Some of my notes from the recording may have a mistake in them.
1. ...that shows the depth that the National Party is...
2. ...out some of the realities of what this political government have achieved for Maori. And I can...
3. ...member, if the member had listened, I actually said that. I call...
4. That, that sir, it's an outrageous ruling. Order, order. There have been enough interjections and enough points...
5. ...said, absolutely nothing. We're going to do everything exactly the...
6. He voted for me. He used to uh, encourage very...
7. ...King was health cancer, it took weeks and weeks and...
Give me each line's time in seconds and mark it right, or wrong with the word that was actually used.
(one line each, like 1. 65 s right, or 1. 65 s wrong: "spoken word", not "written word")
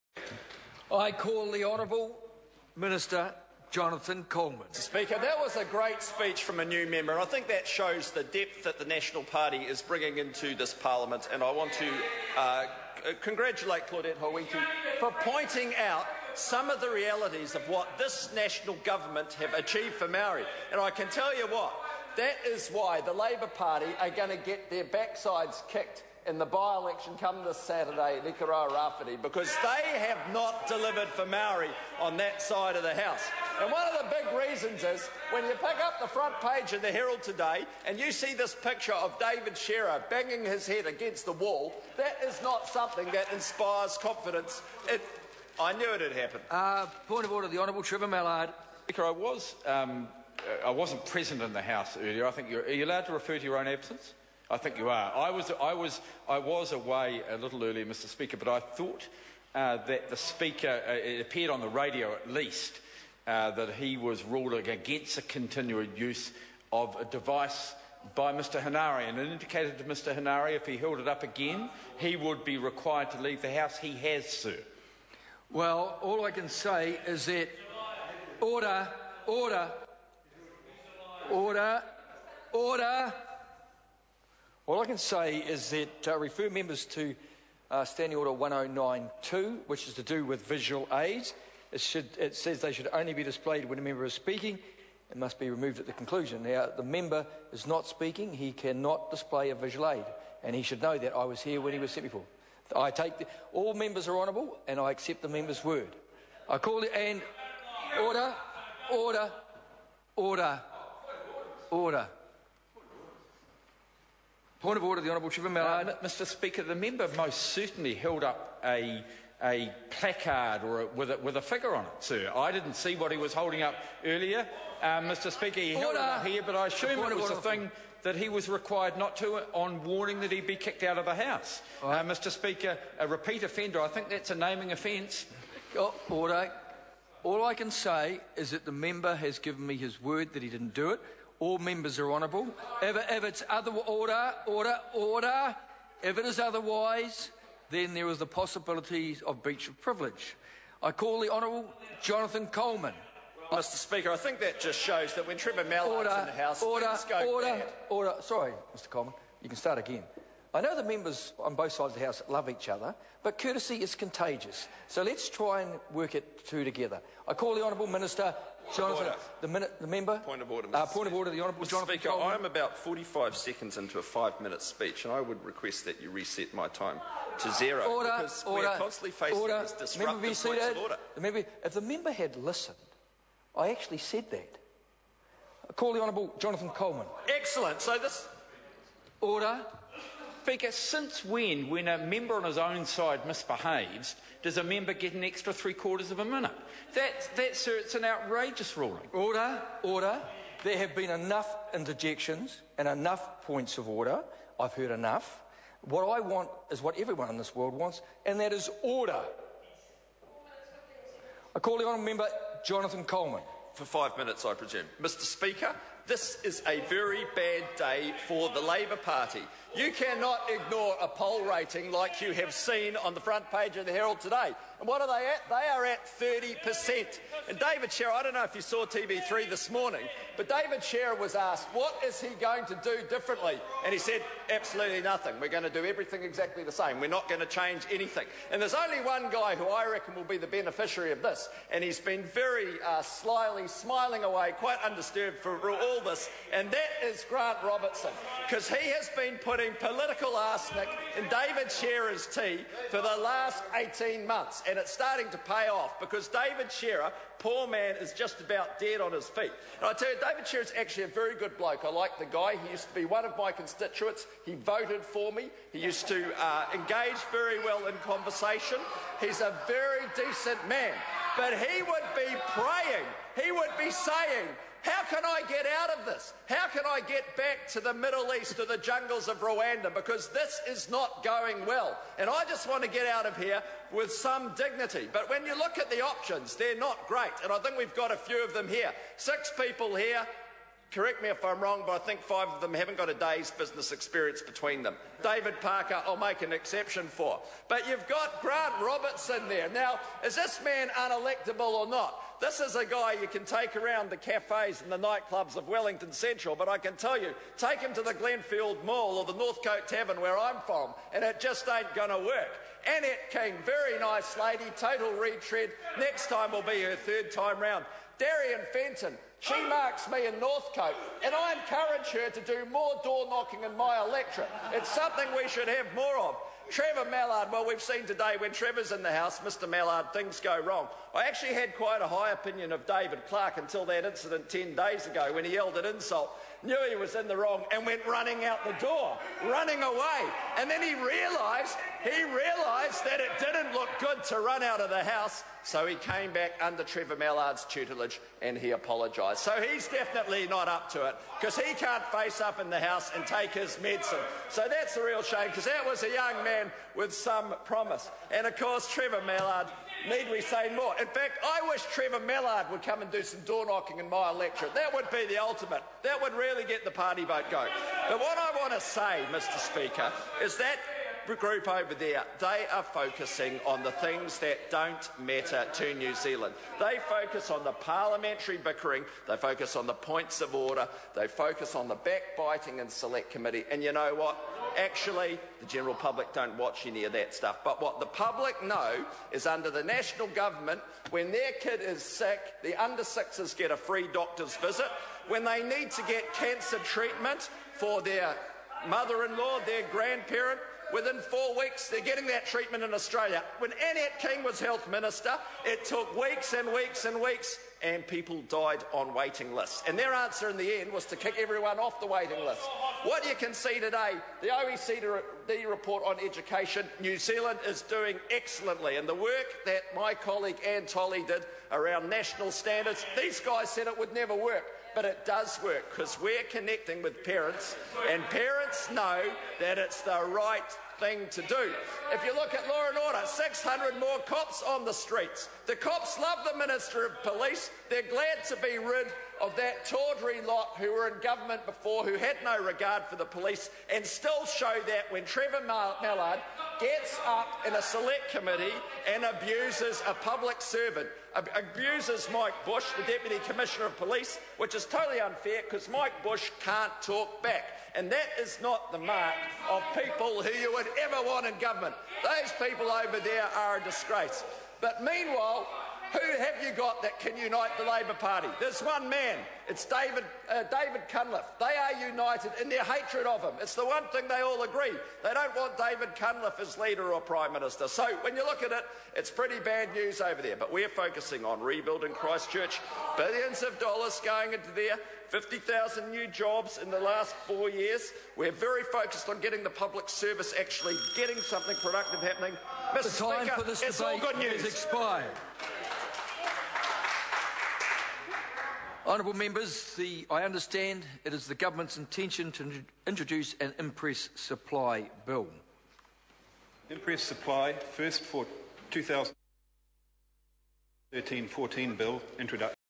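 1. 7 s right
2. 15 s wrong: "national", not "political"
3. 181 s right
4. 196 s right
5. 233 s right
6. 264 s wrong: "engage", not "encourage"
7. 404 s wrong: "minister", not "cancer".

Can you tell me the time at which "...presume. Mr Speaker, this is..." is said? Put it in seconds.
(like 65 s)
214 s.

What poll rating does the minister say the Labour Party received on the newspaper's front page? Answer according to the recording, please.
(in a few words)
30%.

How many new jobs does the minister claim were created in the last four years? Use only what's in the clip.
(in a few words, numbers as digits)
50,000.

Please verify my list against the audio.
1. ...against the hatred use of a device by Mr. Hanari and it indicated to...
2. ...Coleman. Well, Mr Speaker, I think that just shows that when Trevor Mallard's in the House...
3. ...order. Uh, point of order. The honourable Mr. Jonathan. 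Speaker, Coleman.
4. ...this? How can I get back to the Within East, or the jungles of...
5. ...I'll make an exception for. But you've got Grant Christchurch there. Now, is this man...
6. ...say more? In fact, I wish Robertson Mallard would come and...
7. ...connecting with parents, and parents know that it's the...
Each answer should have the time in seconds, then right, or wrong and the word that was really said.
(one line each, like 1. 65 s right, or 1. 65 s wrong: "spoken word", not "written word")
1. 64 s wrong: "continued", not "hatred"
2. 152 s right
3. 170 s right
4. 276 s wrong: "Middle", not "Within"
5. 296 s wrong: "Robertson", not "Christchurch"
6. 360 s wrong: "Trevor", not "Robertson"
7. 426 s right.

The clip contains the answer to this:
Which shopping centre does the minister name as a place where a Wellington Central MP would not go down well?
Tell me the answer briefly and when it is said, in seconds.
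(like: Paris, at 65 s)
Glenfield Mall, at 308 s.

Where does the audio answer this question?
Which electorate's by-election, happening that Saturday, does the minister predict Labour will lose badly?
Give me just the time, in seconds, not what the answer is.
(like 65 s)
28 s.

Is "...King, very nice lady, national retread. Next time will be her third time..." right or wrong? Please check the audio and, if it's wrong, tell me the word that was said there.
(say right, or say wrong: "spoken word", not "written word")
wrong: "total", not "national".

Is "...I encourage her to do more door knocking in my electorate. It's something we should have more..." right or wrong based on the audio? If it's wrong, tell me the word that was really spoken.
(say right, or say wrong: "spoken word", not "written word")
right.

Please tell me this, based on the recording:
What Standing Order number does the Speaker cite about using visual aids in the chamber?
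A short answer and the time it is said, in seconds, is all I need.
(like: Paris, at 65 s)
1092, at 88 s.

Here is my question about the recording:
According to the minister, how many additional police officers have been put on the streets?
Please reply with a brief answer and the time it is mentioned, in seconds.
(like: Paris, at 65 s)
600, at 433 s.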